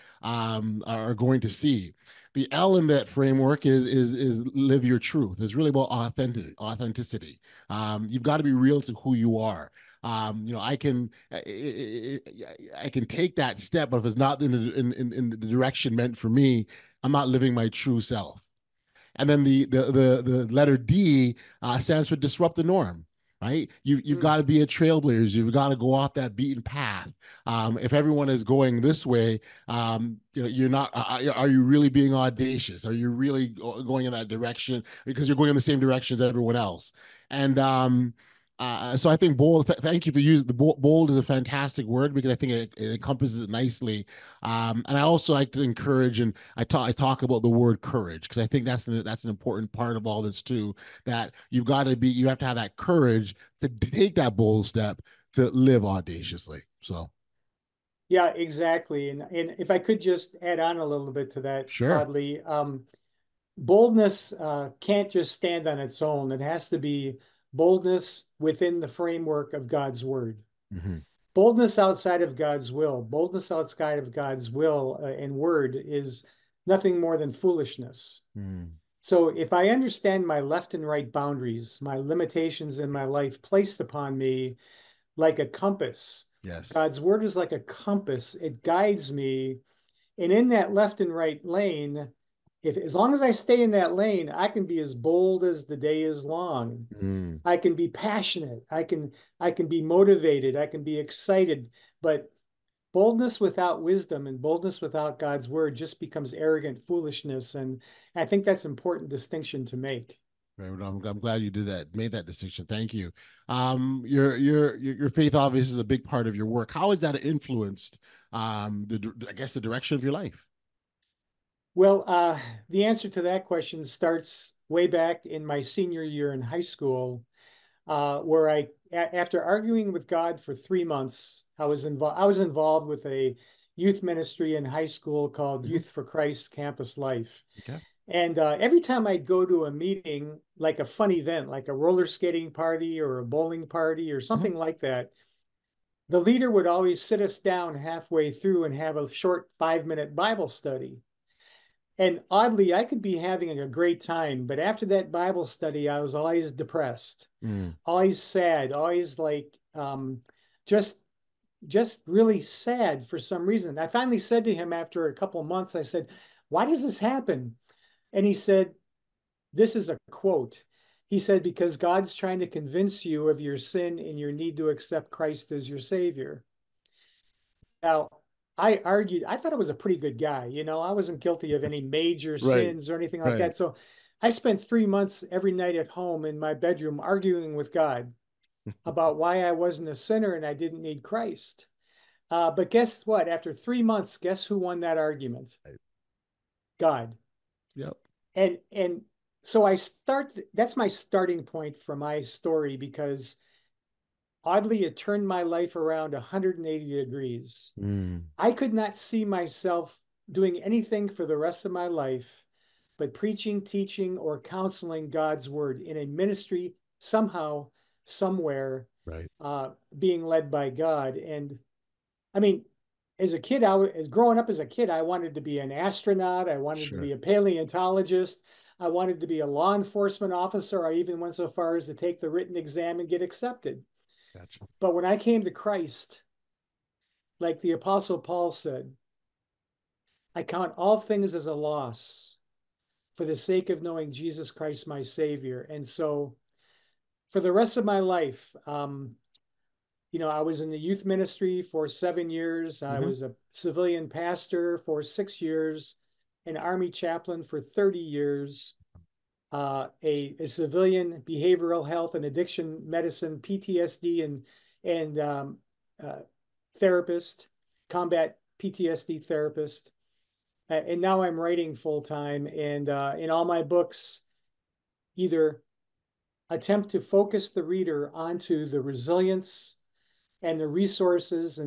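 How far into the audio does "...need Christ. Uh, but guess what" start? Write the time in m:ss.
3:10.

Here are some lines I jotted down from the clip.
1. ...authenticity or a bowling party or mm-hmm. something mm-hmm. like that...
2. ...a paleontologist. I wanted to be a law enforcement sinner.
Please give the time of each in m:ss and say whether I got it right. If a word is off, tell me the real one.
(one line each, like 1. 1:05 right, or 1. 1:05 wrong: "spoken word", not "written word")
1. 2:22 wrong: "party", not "authenticity"
2. 3:47 wrong: "officer", not "sinner".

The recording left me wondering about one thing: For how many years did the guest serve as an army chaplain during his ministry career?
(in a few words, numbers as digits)
30 years.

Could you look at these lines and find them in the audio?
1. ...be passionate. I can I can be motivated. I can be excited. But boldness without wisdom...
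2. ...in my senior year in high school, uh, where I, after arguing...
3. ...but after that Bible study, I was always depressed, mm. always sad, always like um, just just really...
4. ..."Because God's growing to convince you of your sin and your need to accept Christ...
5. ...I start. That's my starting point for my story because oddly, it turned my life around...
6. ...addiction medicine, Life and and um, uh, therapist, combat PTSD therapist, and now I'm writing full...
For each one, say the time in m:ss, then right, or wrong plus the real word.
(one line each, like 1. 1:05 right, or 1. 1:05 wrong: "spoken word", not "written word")
1. 1:37 right
2. 2:05 right
3. 2:34 right
4. 2:51 wrong: "trying", not "growing"
5. 3:19 right
6. 4:22 wrong: "PTSD", not "Life".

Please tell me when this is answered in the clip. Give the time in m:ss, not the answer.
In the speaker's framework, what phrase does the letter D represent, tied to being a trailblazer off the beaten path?
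0:22.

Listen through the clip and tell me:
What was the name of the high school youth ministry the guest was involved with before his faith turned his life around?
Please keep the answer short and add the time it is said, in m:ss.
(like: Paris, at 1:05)
Youth for Christ Campus Life, at 2:15.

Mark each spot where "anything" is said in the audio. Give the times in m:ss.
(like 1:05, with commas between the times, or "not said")
3:02, 3:30.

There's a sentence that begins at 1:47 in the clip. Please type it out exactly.
And I think that's an important distinction to make.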